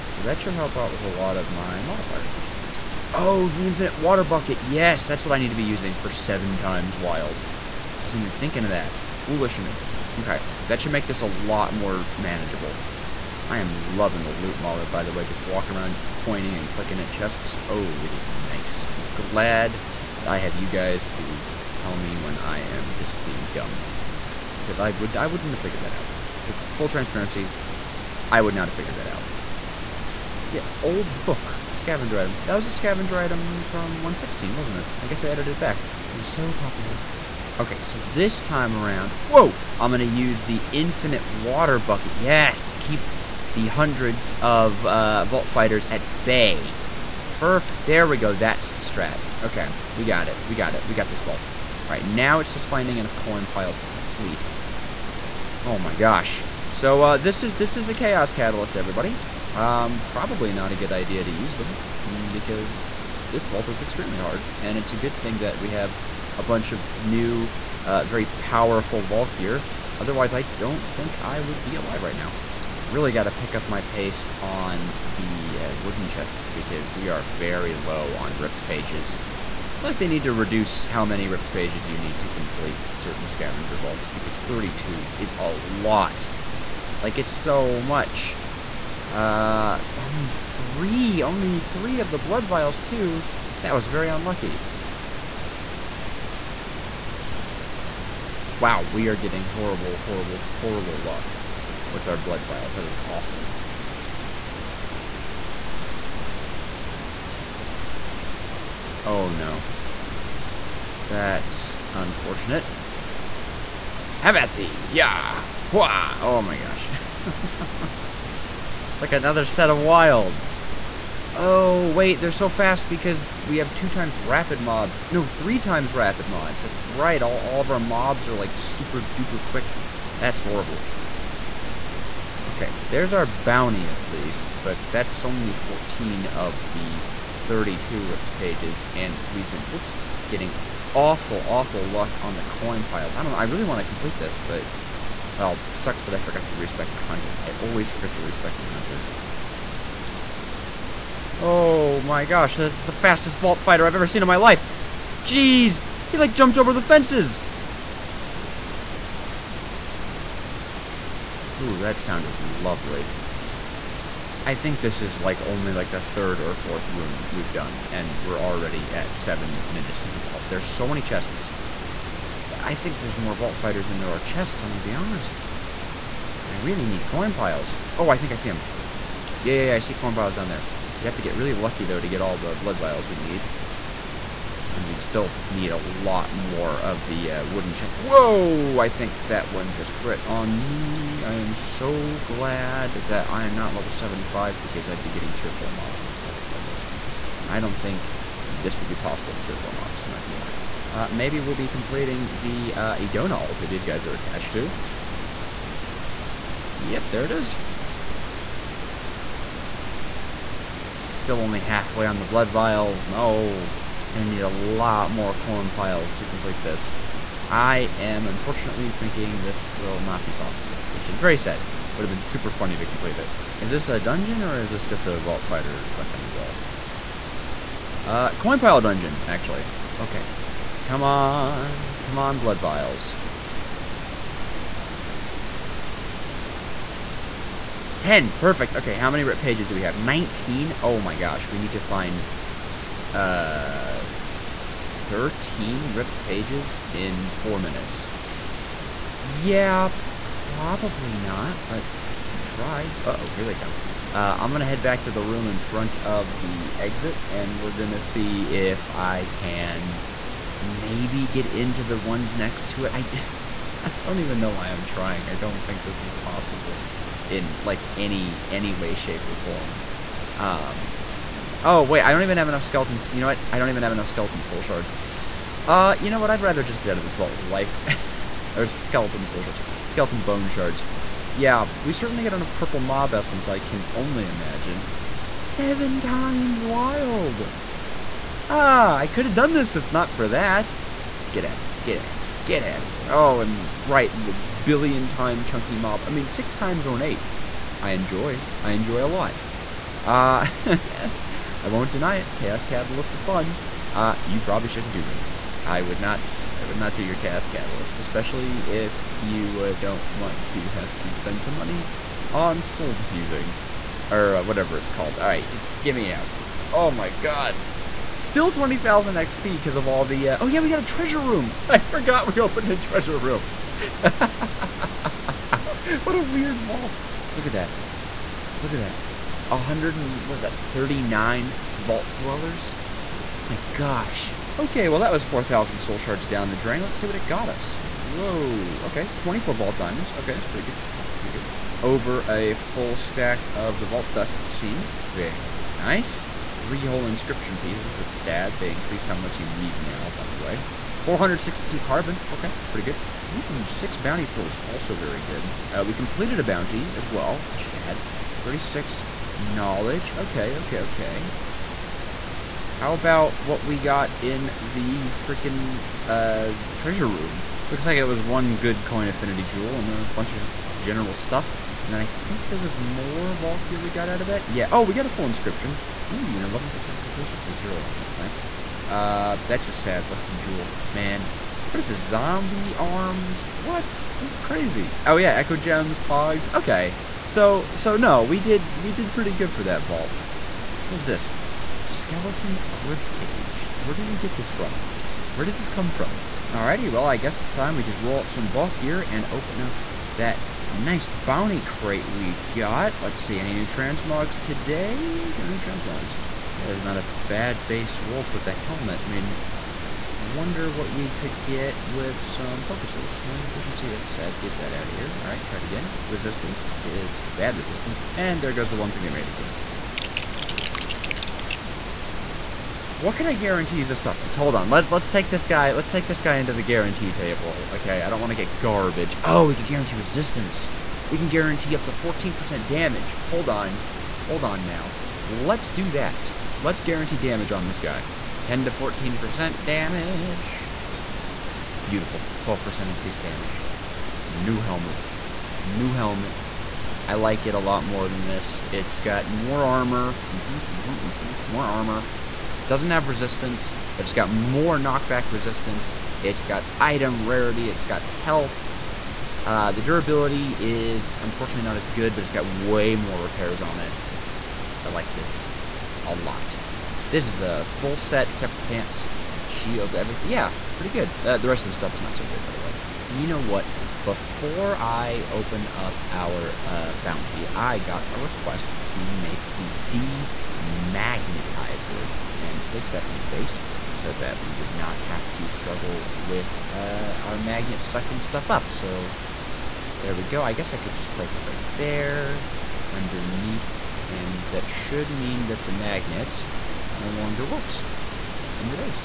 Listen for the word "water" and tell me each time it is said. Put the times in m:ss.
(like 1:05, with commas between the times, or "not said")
0:03, 0:41.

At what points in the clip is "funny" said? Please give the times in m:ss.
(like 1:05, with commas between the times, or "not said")
3:42.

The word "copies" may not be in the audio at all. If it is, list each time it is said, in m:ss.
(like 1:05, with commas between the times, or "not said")
not said.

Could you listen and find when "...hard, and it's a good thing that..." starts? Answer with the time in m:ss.
1:04.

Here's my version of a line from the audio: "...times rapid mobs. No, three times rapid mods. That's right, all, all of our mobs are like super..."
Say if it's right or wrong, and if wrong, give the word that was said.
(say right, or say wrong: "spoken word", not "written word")
right.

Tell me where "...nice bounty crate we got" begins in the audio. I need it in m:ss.
6:40.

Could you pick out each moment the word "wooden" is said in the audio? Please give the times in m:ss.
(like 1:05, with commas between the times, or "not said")
1:15, 3:07.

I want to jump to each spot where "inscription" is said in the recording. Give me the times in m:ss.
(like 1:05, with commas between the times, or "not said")
5:47, 6:15.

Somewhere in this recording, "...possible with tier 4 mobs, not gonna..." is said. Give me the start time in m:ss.
3:18.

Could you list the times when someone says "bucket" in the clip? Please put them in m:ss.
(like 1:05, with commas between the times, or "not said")
0:04, 0:41.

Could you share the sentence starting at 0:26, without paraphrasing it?
Just full transparency, I would not have figured that out.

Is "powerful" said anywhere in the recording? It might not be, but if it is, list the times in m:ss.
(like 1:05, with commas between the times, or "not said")
1:08.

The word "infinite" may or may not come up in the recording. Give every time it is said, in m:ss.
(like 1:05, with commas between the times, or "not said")
0:03, 0:40.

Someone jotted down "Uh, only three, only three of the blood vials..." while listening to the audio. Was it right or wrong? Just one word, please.
right.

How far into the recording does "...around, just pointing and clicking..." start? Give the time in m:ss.
0:15.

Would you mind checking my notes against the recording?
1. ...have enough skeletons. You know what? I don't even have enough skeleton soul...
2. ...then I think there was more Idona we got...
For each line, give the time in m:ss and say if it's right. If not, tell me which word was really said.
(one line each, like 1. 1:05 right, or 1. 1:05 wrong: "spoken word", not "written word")
1. 4:32 right
2. 6:11 wrong: "Valkyr", not "Idona".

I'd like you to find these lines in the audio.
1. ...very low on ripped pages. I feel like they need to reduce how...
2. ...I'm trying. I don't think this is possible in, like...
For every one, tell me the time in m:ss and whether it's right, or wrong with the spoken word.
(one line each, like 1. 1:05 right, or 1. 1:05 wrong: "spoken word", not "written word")
1. 1:17 right
2. 4:24 right.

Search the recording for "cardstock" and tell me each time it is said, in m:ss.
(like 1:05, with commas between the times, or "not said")
not said.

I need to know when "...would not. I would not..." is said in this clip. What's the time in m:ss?
5:05.